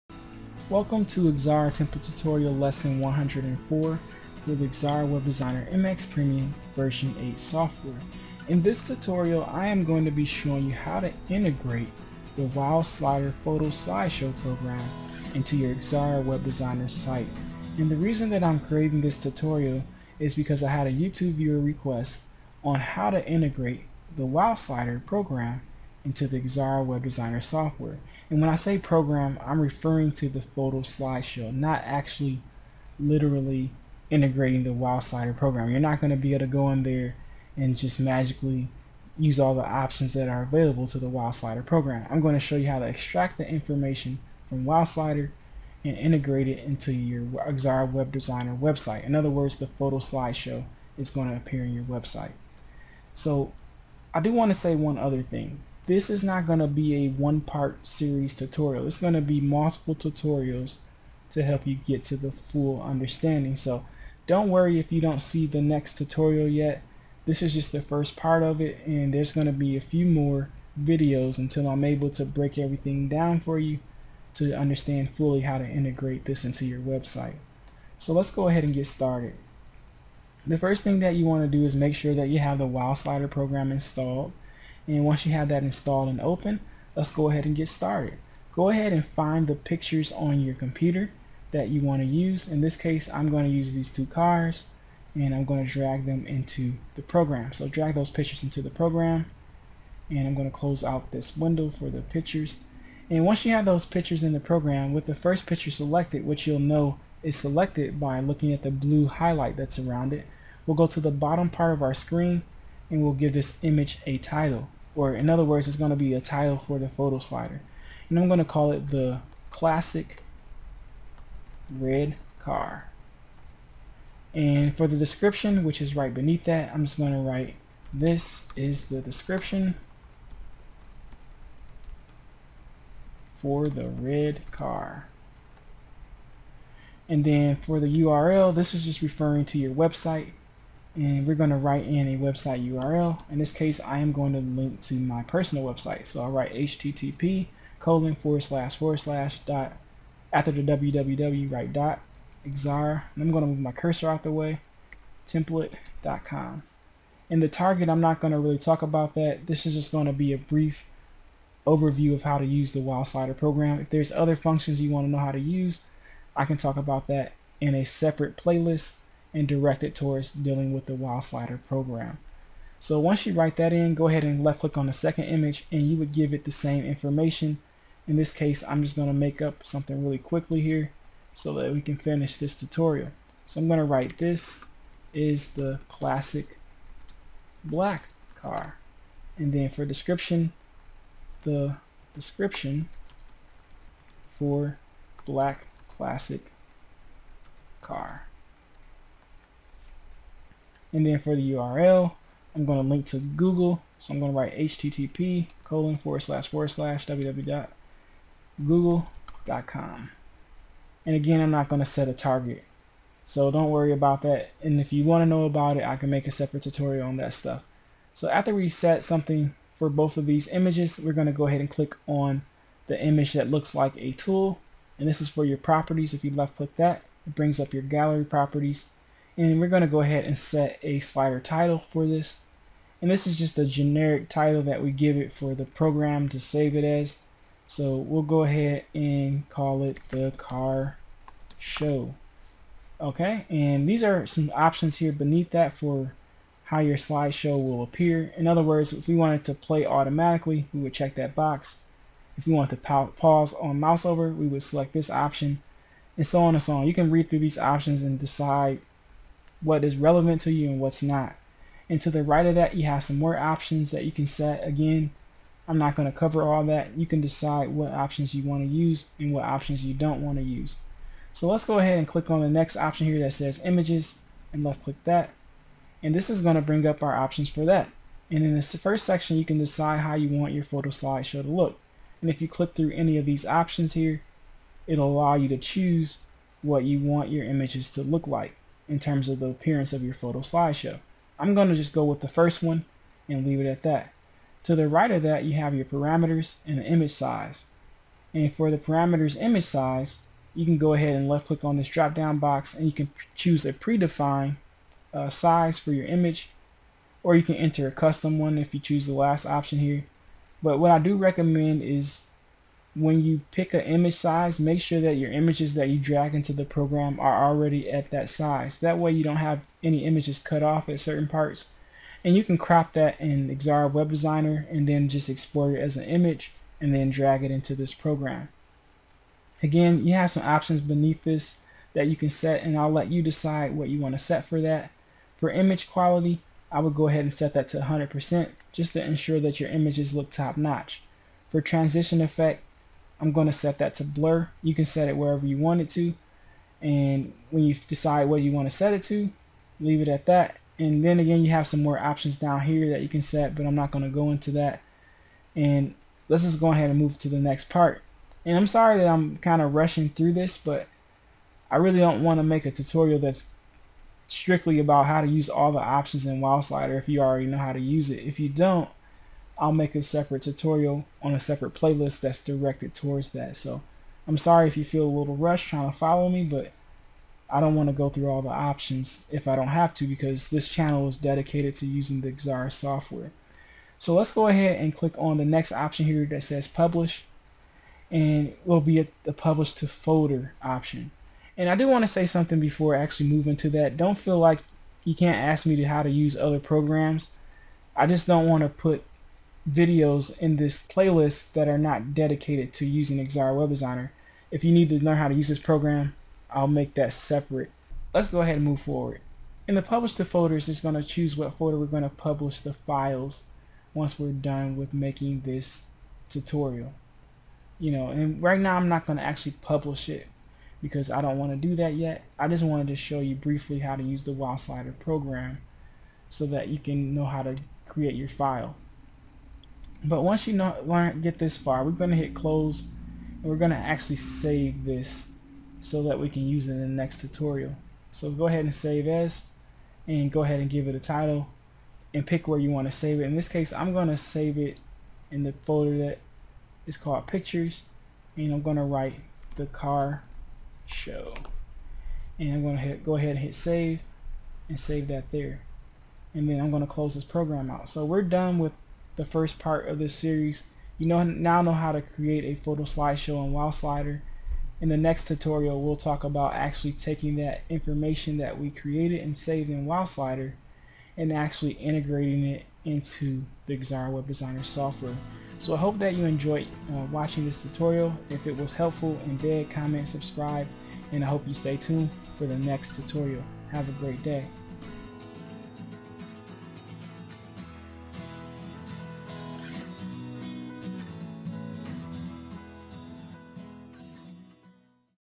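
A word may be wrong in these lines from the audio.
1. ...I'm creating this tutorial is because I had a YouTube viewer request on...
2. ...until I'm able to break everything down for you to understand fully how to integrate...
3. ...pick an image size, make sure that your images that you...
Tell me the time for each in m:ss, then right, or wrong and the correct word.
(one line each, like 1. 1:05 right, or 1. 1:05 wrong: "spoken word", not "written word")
1. 0:18 right
2. 1:11 right
3. 5:13 right.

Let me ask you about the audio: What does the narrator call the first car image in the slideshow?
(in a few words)
the classic red car.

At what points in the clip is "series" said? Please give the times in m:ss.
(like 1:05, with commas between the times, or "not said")
0:57, 7:40.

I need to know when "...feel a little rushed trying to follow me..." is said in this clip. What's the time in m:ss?
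6:14.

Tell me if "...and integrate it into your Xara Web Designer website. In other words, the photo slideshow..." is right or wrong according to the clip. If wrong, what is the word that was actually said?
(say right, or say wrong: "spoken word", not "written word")
right.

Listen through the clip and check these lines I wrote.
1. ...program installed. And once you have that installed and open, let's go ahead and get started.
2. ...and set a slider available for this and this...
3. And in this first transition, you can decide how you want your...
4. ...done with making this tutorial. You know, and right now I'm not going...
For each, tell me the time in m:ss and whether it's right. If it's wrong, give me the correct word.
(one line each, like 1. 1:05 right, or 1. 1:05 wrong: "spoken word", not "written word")
1. 1:23 right
2. 3:50 wrong: "title", not "available"
3. 4:38 wrong: "section", not "transition"
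4. 6:54 right.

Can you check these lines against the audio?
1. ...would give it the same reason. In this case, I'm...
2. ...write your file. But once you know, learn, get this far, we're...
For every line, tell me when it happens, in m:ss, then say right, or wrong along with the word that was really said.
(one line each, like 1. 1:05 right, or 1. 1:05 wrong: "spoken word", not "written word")
1. 2:55 wrong: "information", not "reason"
2. 7:07 wrong: "create", not "write".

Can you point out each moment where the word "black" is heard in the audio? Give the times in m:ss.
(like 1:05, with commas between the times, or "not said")
3:07, 3:15.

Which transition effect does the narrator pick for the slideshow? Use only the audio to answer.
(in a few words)
blur.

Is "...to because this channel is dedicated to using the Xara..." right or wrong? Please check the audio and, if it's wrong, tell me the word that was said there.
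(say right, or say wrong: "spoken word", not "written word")
right.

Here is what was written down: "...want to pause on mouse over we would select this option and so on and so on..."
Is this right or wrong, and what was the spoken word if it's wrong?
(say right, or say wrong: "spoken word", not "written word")
right.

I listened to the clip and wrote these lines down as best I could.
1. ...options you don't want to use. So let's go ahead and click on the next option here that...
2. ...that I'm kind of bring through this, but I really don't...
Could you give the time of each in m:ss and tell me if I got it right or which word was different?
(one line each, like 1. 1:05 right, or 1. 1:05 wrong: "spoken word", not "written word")
1. 4:29 right
2. 5:58 wrong: "rushing", not "bring".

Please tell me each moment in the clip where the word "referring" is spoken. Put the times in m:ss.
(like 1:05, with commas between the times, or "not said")
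0:29, 2:19.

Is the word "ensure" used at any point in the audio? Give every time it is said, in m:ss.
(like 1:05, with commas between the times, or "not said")
5:39.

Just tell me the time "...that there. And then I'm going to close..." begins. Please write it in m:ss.
7:35.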